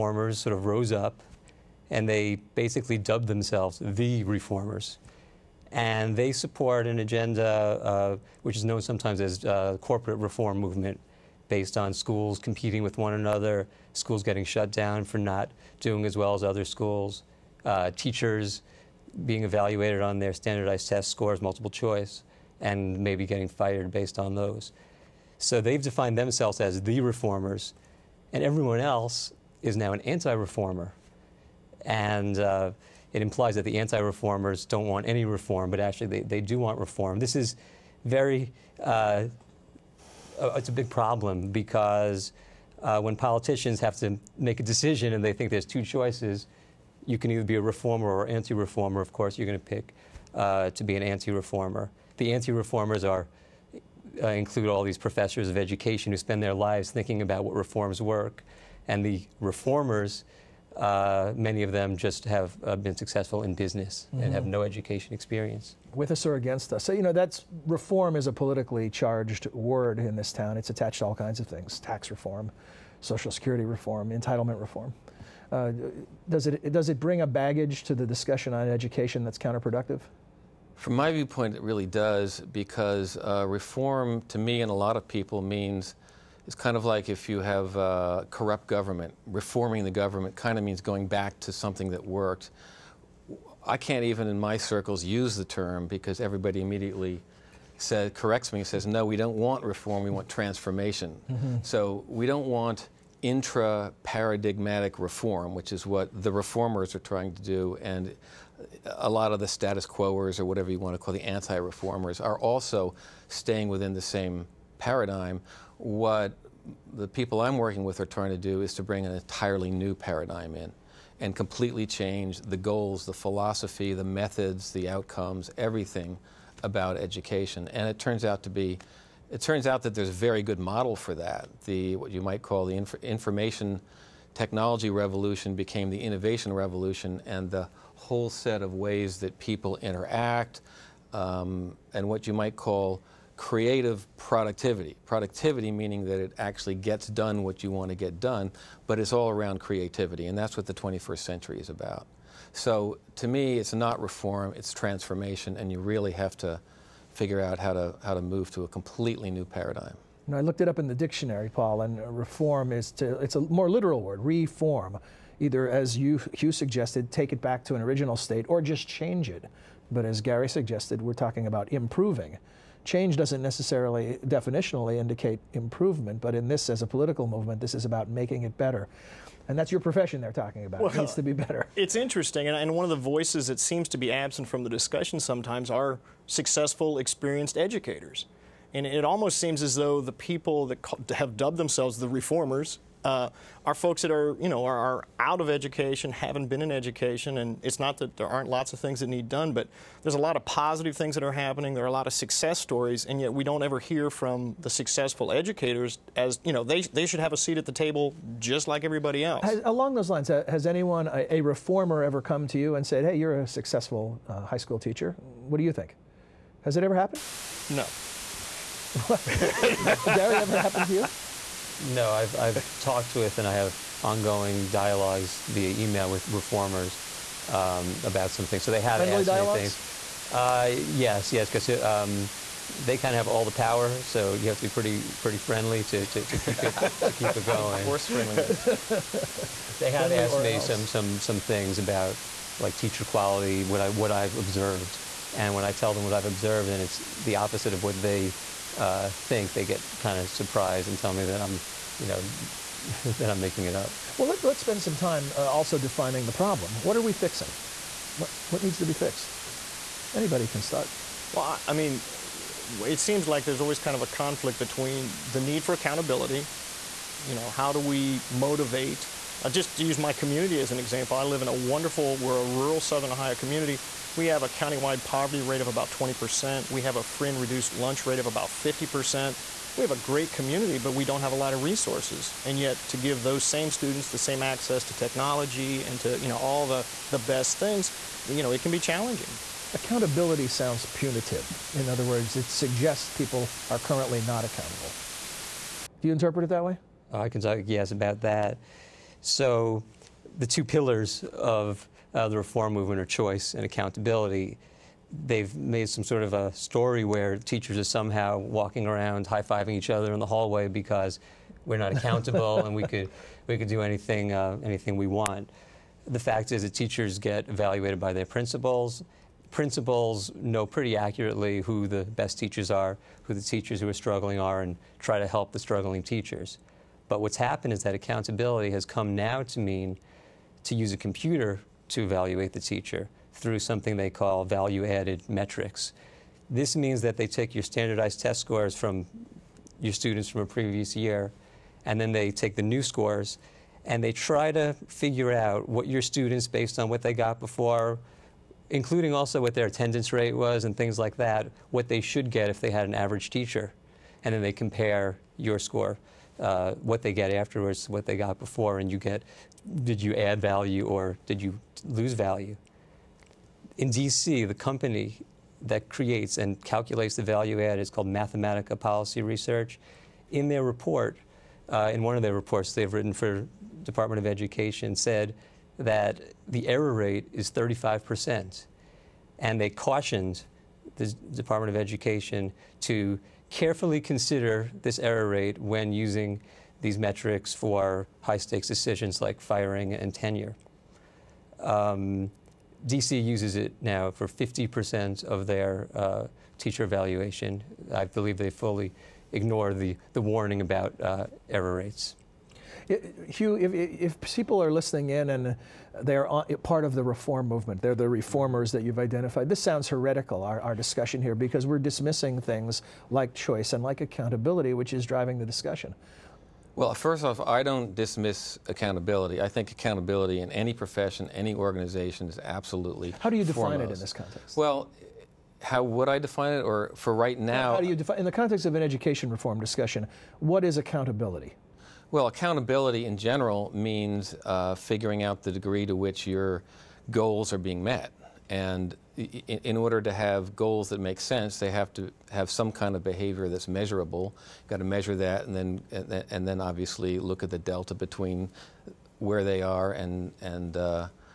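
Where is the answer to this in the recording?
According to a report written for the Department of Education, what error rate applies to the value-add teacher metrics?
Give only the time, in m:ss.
6:17.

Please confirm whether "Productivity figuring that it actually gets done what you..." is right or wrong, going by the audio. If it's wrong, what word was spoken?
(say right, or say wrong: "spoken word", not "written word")
wrong: "meaning", not "figuring".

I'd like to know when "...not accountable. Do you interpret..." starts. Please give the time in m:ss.
4:54.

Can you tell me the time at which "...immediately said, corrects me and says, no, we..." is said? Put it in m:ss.
1:36.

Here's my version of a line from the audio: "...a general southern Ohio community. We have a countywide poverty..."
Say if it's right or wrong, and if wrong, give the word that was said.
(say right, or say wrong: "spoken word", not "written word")
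wrong: "rural", not "general".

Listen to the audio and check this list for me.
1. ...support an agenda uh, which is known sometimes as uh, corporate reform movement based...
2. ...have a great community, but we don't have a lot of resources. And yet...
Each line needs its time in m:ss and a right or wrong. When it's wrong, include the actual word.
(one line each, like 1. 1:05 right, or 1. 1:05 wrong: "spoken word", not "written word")
1. 0:06 right
2. 4:39 right.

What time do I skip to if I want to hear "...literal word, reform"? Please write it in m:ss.
2:43.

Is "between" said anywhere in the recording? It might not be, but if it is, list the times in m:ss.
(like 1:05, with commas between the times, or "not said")
4:24, 7:27.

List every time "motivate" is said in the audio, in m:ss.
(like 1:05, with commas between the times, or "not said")
4:28.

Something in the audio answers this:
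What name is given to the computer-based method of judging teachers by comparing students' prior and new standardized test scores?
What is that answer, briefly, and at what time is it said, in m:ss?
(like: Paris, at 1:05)
value added metrics, at 5:34.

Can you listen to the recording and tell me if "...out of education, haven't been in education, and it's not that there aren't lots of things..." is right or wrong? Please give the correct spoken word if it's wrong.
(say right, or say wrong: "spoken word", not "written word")
right.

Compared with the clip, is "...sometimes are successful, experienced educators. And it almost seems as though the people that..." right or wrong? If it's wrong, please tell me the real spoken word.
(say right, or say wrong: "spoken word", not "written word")
right.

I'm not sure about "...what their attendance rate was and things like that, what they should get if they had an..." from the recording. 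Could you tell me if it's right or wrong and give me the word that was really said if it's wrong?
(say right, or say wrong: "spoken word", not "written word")
right.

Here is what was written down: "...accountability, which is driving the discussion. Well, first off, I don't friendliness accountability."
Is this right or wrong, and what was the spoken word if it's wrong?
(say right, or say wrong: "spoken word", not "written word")
wrong: "dismiss", not "friendliness".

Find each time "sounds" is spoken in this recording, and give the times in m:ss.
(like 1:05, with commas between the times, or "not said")
4:50, 6:49.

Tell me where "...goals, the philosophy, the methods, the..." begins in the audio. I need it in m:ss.
2:02.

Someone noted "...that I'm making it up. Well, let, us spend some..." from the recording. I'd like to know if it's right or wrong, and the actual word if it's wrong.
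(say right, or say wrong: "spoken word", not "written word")
right.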